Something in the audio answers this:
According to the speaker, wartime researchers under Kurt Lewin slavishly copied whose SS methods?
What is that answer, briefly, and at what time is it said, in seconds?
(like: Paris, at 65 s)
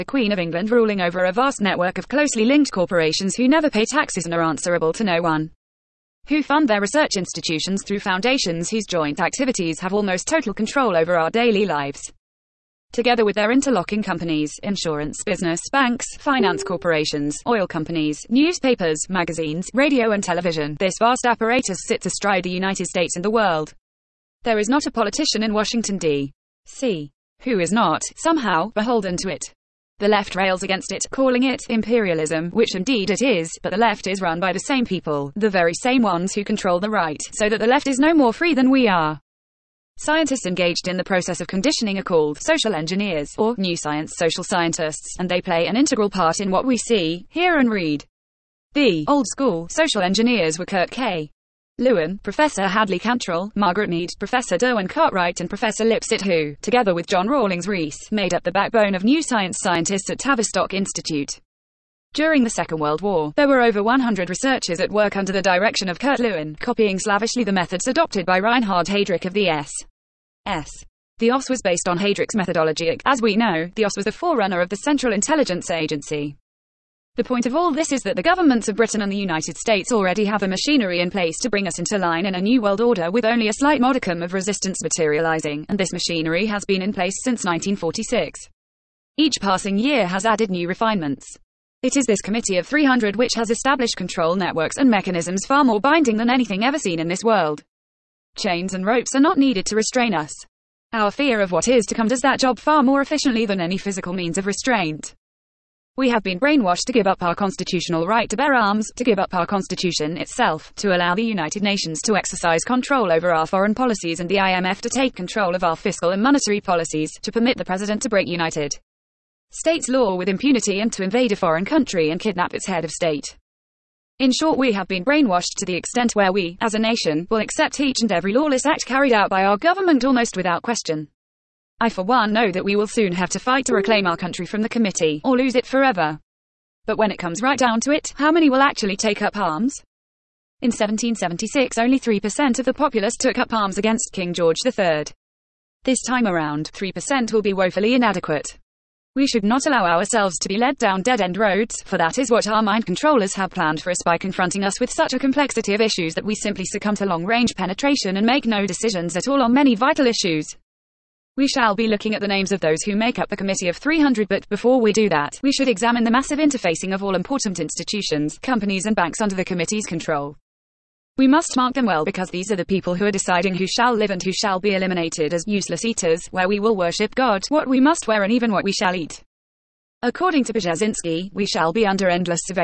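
Reinhard Heydrich, at 68 s.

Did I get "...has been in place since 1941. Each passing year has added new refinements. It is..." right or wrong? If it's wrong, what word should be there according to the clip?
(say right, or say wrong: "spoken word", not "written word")
wrong: "1946", not "1941".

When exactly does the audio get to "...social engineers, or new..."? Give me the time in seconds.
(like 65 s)
42 s.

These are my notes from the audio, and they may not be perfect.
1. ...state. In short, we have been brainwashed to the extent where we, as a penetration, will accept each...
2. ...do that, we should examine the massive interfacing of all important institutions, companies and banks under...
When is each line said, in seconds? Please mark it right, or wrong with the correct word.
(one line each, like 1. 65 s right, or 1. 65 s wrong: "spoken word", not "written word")
1. 122 s wrong: "nation", not "penetration"
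2. 164 s right.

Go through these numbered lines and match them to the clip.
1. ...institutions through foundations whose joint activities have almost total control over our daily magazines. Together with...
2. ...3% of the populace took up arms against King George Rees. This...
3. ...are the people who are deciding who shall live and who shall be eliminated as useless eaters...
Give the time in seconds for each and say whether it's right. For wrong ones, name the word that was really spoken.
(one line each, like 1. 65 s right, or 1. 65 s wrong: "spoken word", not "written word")
1. 7 s wrong: "lives", not "magazines"
2. 141 s wrong: "III", not "Rees"
3. 172 s right.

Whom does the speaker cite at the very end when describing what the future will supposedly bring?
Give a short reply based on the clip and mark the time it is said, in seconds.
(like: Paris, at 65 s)
Brzezinski, at 180 s.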